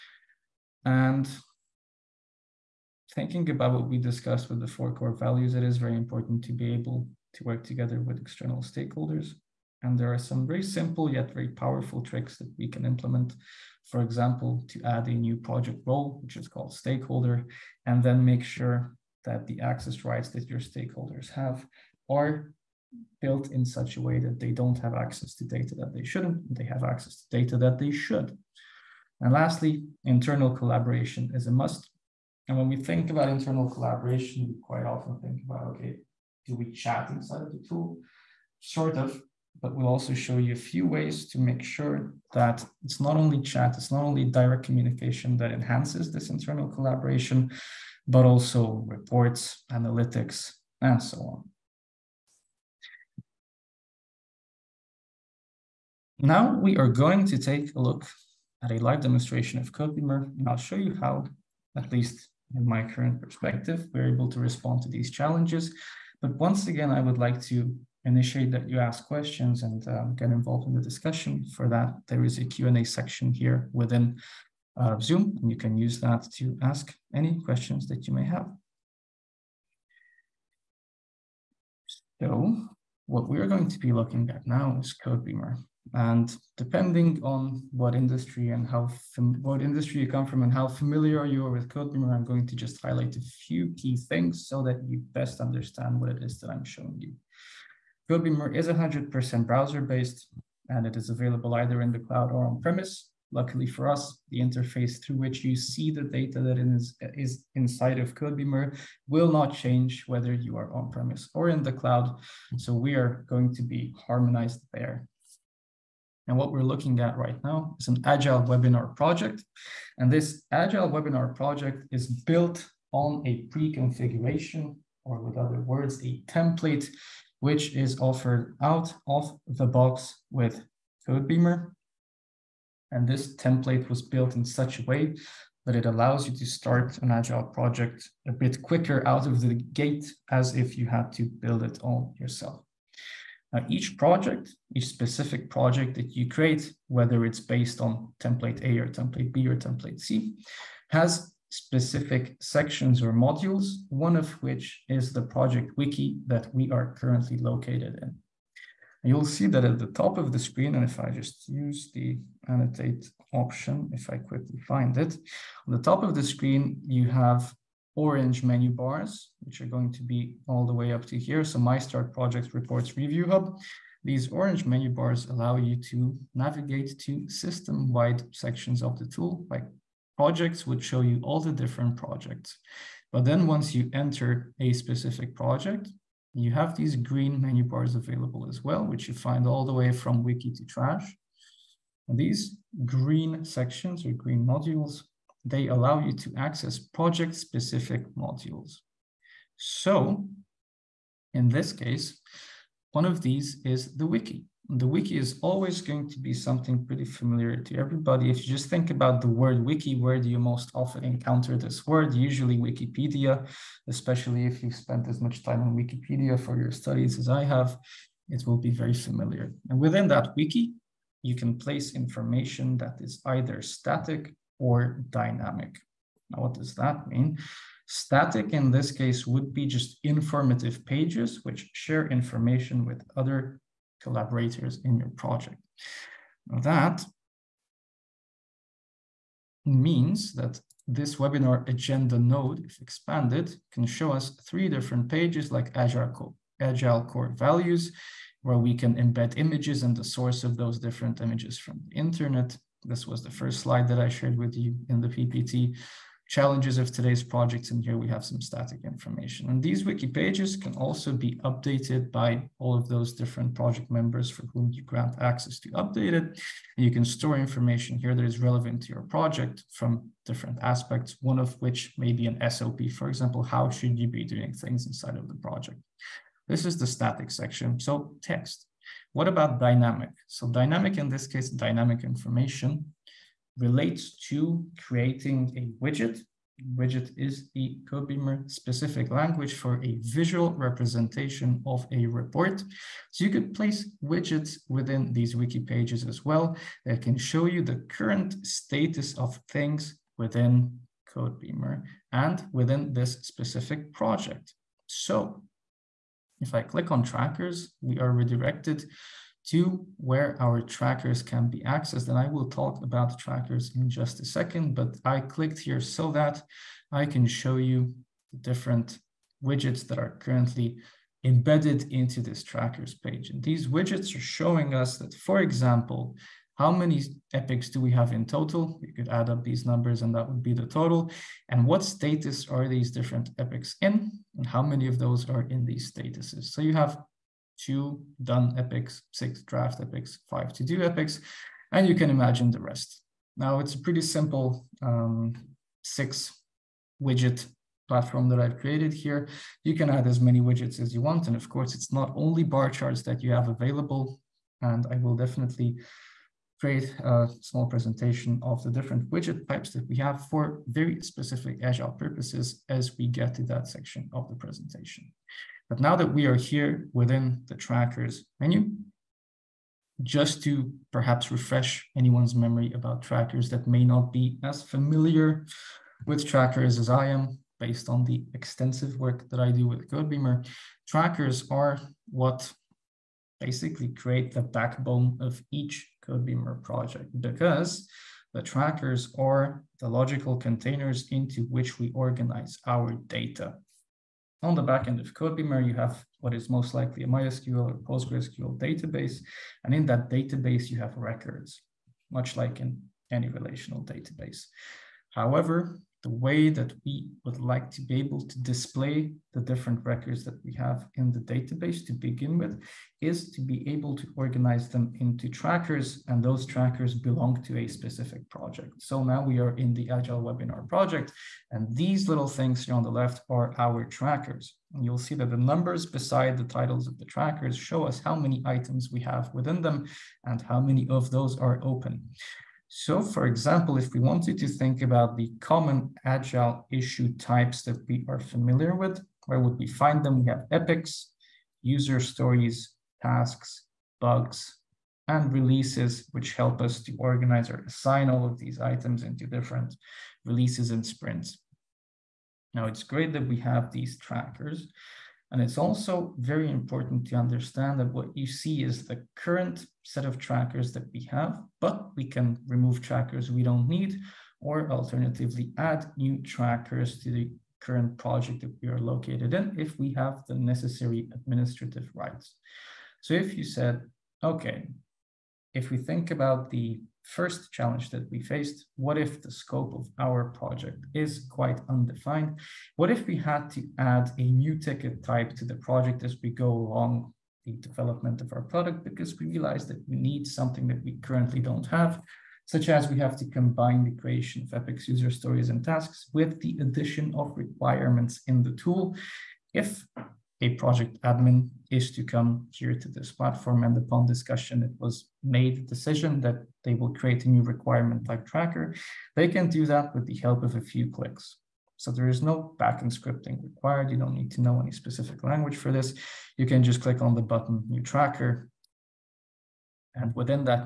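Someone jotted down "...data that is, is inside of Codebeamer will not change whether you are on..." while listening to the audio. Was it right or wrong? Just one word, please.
right.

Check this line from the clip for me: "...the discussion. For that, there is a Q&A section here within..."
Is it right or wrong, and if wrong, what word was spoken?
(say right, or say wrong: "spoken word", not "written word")
right.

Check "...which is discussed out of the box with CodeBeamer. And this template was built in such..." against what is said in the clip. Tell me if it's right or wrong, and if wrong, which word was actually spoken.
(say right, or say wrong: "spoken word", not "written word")
wrong: "offered", not "discussed".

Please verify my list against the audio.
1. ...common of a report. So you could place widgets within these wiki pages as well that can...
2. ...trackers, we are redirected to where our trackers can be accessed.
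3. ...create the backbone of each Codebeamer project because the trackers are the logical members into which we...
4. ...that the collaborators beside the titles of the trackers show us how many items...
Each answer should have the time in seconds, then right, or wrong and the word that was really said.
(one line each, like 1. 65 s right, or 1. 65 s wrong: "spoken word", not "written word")
1. 290 s wrong: "representation", not "common"
2. 307 s right
3. 383 s wrong: "containers", not "members"
4. 425 s wrong: "numbers", not "collaborators".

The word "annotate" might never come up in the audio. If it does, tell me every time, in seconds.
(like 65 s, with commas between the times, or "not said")
162 s.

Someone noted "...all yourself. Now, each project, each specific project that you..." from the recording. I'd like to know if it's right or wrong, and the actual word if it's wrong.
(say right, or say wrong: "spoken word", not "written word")
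right.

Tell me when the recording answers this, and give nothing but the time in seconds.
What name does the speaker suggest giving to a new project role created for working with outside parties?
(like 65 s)
16 s.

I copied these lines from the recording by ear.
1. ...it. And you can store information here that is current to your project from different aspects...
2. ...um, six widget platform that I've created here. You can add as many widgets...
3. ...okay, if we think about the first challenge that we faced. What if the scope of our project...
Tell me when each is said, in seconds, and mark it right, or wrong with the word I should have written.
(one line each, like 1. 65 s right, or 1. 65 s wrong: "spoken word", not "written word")
1. 266 s wrong: "relevant", not "current"
2. 344 s right
3. 474 s right.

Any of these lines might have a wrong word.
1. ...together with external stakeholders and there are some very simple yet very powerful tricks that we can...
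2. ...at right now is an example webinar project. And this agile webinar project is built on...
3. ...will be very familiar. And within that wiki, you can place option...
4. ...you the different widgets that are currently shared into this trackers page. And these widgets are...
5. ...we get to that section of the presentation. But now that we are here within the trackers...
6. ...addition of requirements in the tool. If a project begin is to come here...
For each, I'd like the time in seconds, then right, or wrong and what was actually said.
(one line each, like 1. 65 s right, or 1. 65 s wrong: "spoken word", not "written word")
1. 7 s right
2. 117 s wrong: "agile", not "example"
3. 218 s wrong: "information", not "option"
4. 317 s wrong: "embedded", not "shared"
5. 362 s right
6. 496 s wrong: "admin", not "begin".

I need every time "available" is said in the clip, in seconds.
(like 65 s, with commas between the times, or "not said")
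101 s, 187 s, 353 s.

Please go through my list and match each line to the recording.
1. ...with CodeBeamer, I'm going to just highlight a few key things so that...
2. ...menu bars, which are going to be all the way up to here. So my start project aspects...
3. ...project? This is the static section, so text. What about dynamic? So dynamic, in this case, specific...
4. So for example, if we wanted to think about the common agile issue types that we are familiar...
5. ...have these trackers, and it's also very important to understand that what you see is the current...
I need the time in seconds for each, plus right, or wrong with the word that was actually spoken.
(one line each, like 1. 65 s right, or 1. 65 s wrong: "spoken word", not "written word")
1. 91 s right
2. 168 s wrong: "reports", not "aspects"
3. 275 s wrong: "dynamic", not "specific"
4. 432 s right
5. 453 s right.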